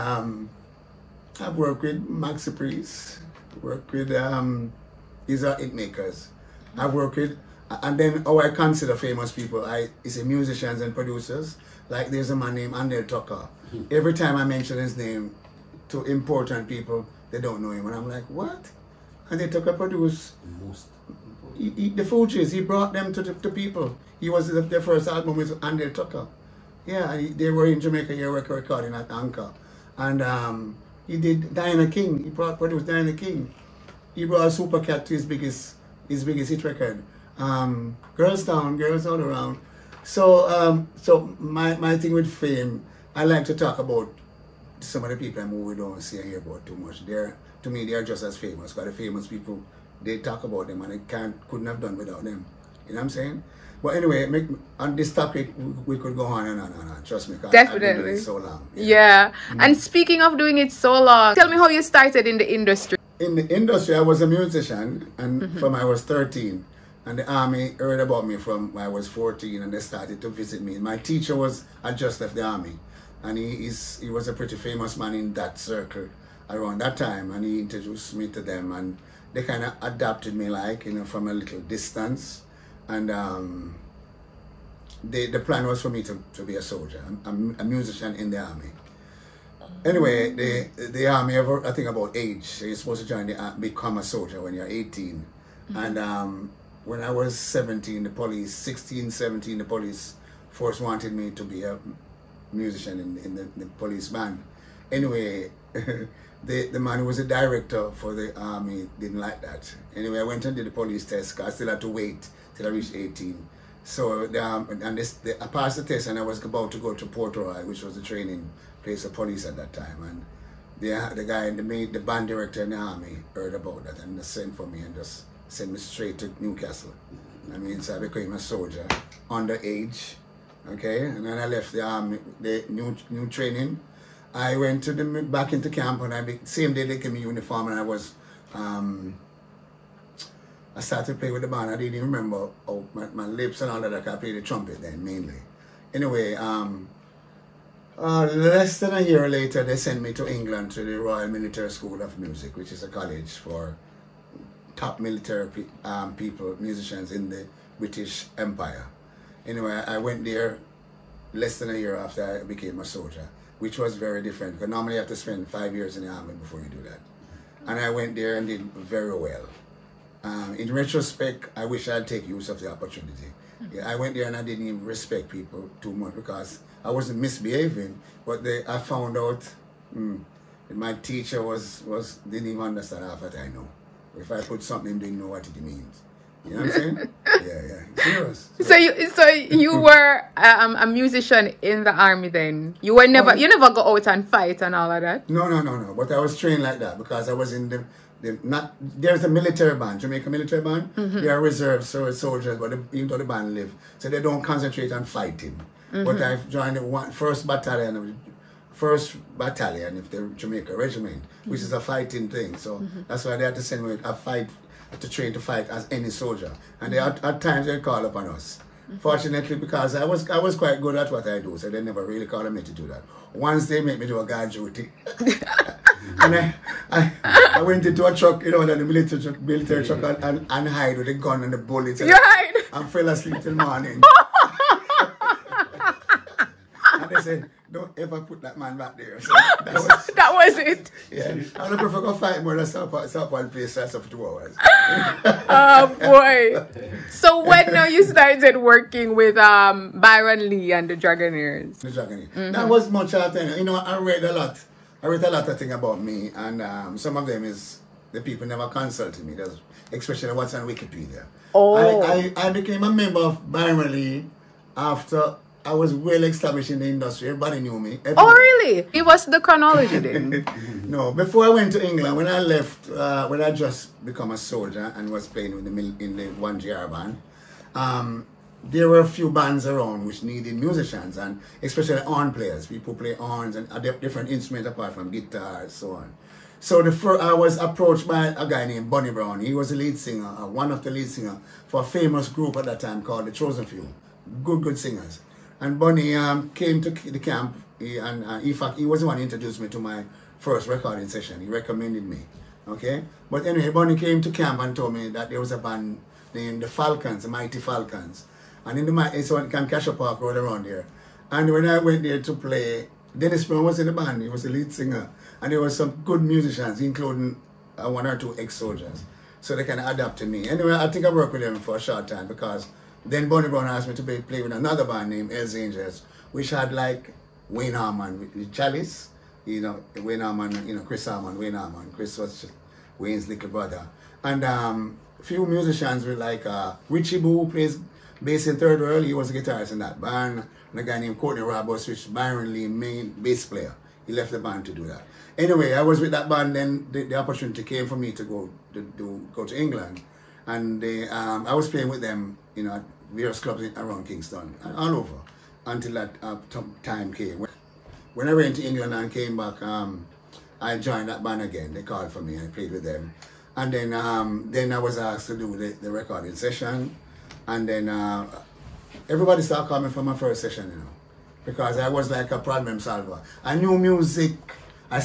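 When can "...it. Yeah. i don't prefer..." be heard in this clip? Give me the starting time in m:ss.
4:00.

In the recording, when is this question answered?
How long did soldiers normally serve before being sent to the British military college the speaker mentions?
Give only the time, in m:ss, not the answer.
2:45.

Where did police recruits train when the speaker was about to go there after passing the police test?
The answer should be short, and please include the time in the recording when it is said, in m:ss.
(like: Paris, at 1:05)
Port Royal, at 1:57.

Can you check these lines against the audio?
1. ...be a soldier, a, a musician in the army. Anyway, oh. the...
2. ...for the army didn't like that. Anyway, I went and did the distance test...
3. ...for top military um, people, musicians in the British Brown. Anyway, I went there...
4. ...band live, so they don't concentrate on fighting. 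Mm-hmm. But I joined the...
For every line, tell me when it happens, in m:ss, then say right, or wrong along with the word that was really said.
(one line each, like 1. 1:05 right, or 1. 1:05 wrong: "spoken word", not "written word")
1. 1:26 right
2. 1:47 wrong: "police", not "distance"
3. 2:33 wrong: "Empire", not "Brown"
4. 3:23 right.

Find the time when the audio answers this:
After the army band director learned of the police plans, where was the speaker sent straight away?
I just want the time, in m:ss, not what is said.
2:06.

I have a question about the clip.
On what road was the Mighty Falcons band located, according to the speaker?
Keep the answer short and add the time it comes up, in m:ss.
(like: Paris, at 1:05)
Camcasha Park Road, at 5:09.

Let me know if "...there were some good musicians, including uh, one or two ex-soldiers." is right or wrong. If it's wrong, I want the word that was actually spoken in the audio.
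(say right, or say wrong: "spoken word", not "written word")
right.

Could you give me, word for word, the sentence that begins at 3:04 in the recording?
Or if I put something, they know what it means.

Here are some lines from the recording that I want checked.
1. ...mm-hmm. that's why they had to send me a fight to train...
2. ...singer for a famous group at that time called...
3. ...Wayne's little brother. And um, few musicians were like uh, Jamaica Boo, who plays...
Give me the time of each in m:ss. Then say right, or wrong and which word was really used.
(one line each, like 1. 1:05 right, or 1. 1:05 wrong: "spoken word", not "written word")
1. 3:32 right
2. 4:51 right
3. 5:32 wrong: "Richie", not "Jamaica".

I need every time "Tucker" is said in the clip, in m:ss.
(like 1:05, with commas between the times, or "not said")
0:13, 0:19, 0:25.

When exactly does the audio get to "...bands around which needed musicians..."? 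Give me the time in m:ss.
4:39.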